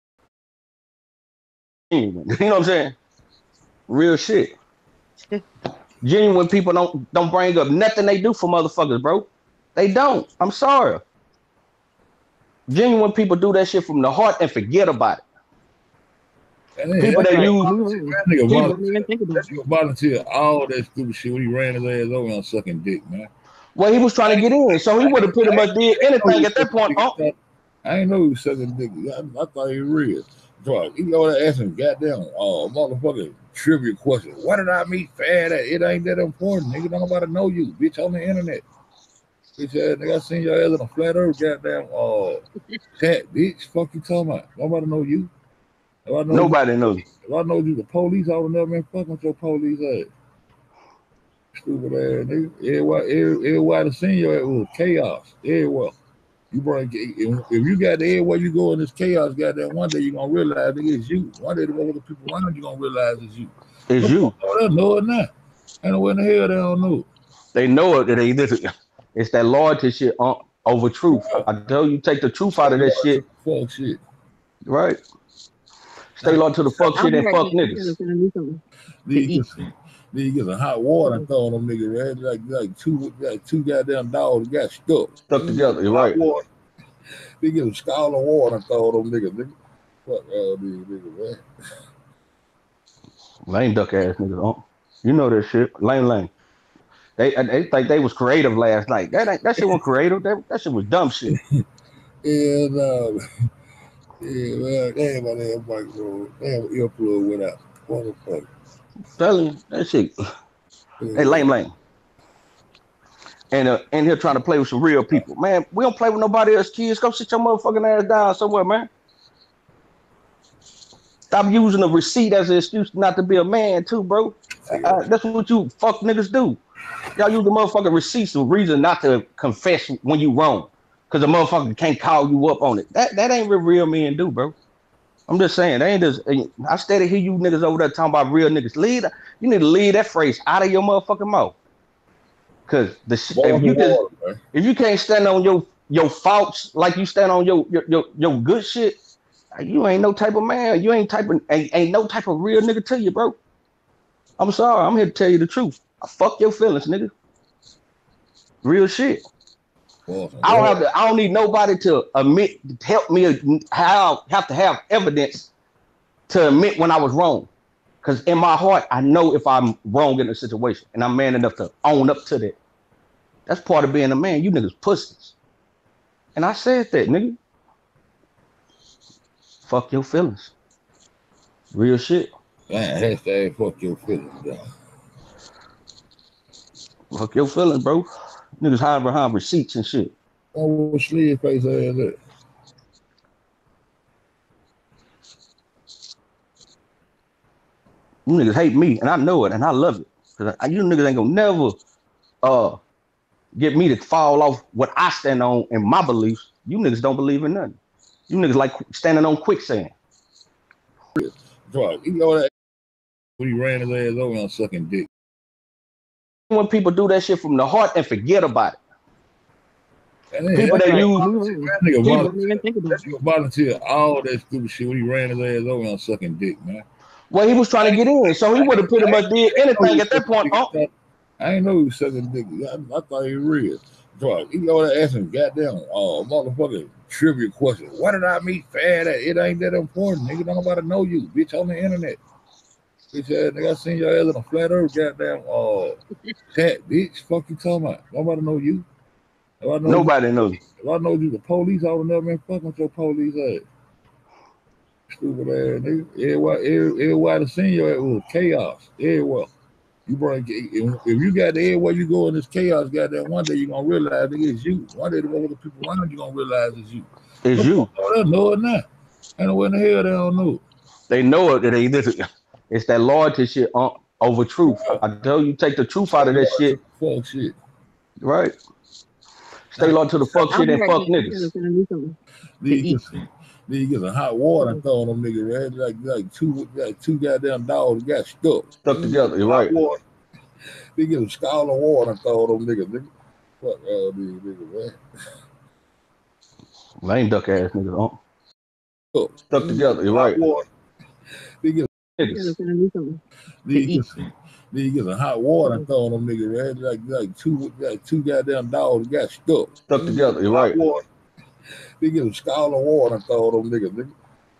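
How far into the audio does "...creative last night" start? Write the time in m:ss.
1:38.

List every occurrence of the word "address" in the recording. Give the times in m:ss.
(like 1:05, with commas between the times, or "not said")
not said.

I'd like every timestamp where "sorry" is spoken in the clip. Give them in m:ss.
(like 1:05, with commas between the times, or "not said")
0:10, 2:34.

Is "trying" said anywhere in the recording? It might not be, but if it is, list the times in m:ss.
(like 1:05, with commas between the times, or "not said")
0:24, 1:54, 3:47.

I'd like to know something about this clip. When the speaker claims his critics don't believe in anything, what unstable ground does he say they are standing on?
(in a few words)
quicksand.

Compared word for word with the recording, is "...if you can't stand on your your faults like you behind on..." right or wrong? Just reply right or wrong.
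wrong.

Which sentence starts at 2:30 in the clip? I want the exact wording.
You ain't type of ain't, ain't no type of real nigga to you, bro.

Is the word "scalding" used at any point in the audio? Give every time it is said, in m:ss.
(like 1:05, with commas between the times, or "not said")
1:27, 4:51.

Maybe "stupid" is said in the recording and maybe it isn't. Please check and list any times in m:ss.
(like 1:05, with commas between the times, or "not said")
0:20, 0:51, 3:44, 4:15.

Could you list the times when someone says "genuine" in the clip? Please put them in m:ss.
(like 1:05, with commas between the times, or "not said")
0:01, 0:06, 0:12.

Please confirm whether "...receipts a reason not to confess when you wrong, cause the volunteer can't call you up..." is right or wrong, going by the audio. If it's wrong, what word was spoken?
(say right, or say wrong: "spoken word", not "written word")
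wrong: "motherfucker", not "volunteer".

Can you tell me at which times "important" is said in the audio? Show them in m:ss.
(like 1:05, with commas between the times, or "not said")
0:36, 3:59.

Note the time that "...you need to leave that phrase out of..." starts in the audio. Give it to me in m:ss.
2:19.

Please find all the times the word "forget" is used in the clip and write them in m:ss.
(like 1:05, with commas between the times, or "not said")
0:14, 3:38.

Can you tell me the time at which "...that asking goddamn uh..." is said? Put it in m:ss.
0:31.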